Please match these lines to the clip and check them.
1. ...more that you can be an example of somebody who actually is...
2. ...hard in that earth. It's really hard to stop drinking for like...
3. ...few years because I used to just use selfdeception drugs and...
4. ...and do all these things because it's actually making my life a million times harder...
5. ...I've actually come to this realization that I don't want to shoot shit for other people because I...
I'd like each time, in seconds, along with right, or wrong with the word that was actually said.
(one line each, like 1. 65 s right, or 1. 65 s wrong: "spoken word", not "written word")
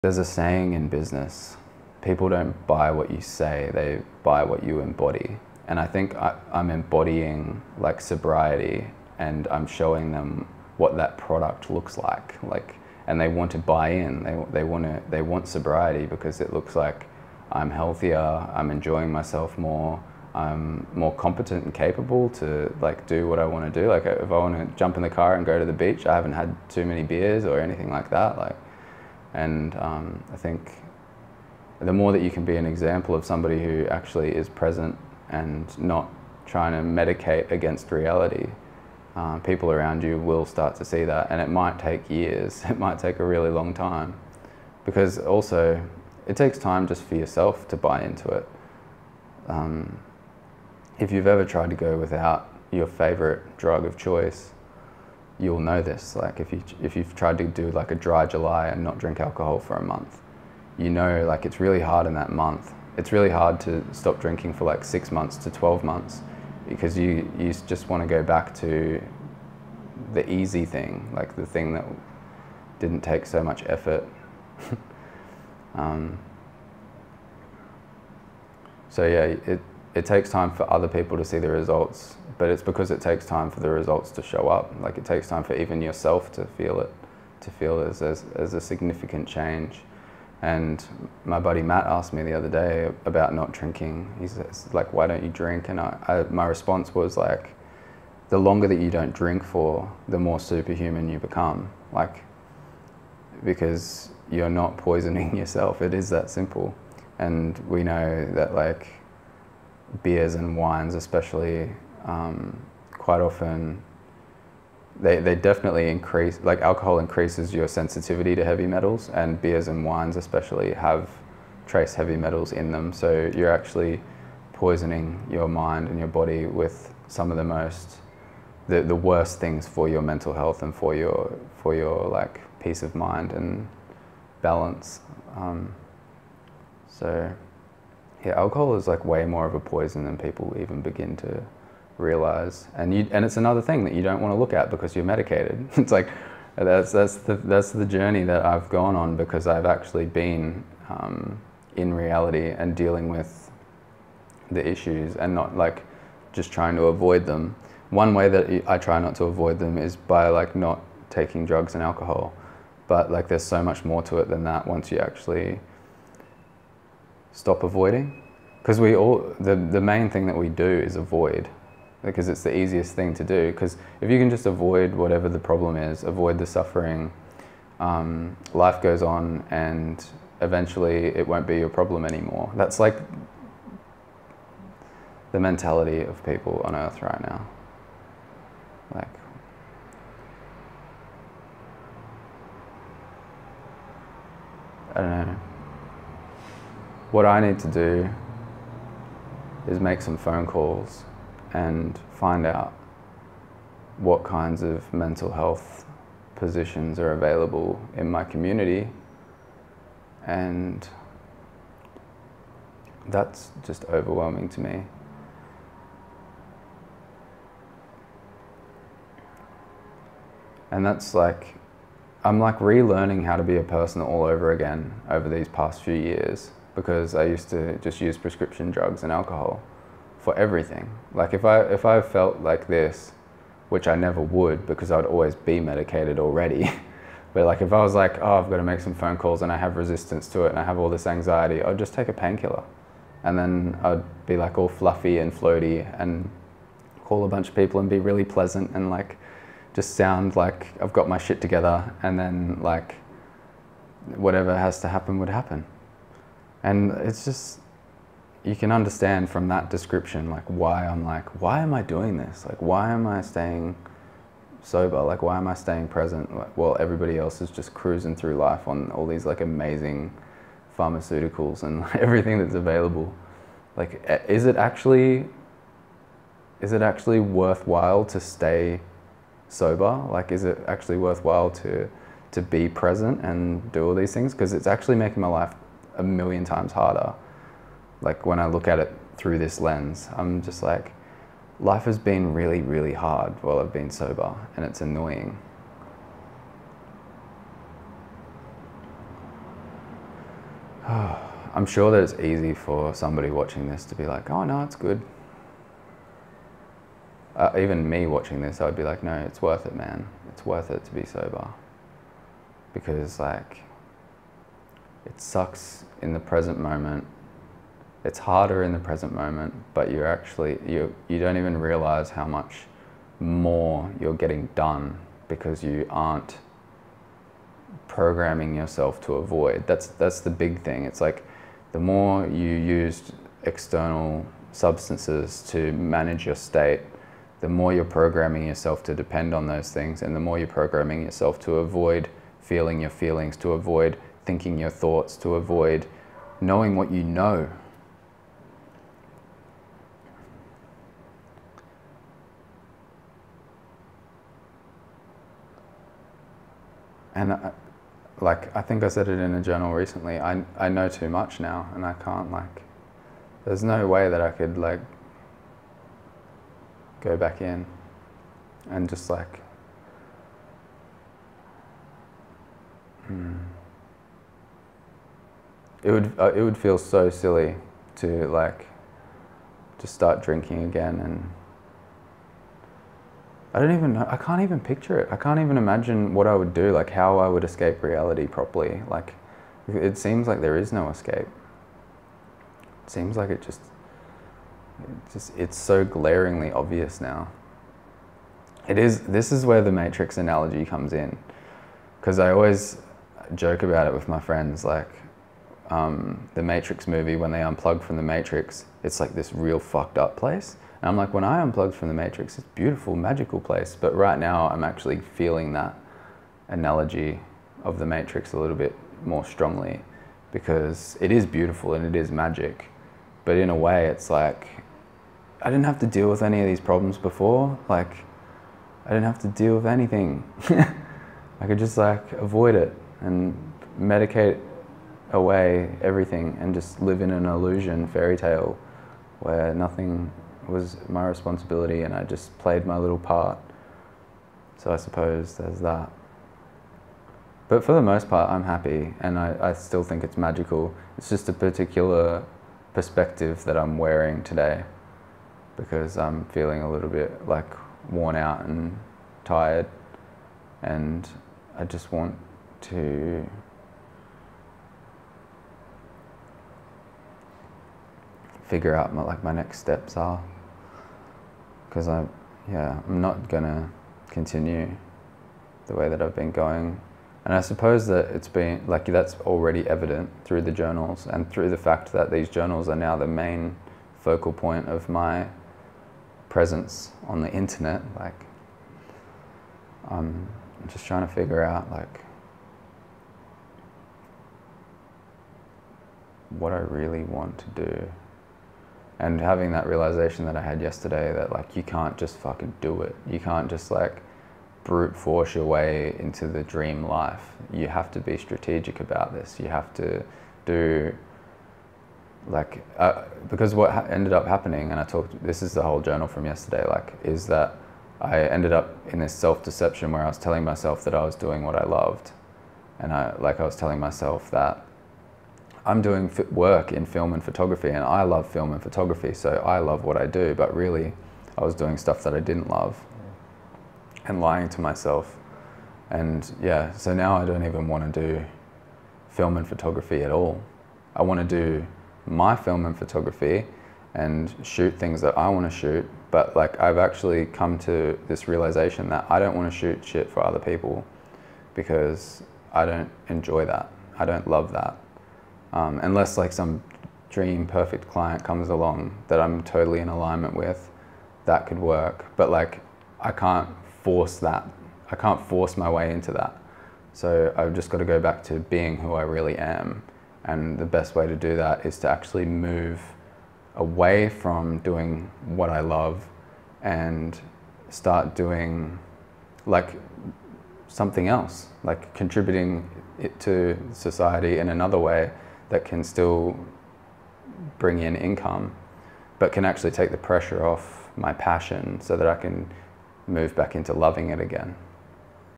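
1. 31 s right
2. 61 s wrong: "month", not "earth"
3. 225 s wrong: "prescription", not "selfdeception"
4. 283 s right
5. 546 s right.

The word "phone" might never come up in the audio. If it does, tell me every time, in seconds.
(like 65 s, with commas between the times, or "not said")
200 s, 238 s.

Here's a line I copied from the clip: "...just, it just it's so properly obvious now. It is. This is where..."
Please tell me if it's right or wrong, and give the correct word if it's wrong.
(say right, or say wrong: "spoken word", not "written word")
wrong: "glaringly", not "properly".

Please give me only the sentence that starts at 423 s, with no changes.
But in a way, it's like I didn't have to deal with any of these problems before.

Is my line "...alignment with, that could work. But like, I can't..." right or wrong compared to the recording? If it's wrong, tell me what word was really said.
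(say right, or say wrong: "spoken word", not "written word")
right.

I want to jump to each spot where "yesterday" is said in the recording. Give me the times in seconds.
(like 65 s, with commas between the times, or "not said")
500 s, 516 s.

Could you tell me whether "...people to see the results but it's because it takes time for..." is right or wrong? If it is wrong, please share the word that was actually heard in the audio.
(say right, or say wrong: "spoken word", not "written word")
right.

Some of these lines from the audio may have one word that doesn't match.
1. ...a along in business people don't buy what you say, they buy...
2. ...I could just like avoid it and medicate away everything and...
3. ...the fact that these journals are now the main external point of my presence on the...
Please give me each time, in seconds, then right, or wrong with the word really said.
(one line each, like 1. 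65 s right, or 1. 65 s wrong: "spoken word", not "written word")
1. 0 s wrong: "saying", not "along"
2. 430 s right
3. 481 s wrong: "focal", not "external".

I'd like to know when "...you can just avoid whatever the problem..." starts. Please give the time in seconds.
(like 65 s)
174 s.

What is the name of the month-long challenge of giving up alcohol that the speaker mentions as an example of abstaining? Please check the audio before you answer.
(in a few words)
dry July.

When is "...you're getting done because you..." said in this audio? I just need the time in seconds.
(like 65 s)
323 s.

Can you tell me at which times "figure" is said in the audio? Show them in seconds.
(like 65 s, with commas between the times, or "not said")
468 s, 491 s.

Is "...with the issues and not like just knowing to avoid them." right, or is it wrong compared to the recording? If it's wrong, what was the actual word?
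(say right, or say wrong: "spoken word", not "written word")
wrong: "trying", not "knowing".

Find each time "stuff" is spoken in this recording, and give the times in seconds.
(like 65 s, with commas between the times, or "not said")
531 s.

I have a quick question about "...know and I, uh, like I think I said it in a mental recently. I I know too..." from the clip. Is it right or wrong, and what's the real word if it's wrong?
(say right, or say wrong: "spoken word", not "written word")
wrong: "journal", not "mental".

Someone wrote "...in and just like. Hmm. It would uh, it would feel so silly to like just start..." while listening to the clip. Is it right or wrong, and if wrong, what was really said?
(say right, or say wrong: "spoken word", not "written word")
right.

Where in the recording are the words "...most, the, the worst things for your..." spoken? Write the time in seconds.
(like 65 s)
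127 s.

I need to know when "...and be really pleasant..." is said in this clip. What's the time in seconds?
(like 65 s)
247 s.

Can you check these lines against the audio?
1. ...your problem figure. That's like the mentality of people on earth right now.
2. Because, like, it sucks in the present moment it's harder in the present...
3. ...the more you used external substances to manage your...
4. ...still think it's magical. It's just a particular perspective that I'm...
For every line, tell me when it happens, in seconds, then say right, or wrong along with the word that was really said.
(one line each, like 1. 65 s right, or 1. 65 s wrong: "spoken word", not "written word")
1. 181 s wrong: "anymore", not "figure"
2. 312 s right
3. 331 s right
4. 449 s right.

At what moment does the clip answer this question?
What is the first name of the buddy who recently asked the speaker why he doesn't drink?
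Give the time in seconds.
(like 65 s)
91 s.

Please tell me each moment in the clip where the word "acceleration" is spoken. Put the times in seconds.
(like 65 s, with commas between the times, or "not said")
not said.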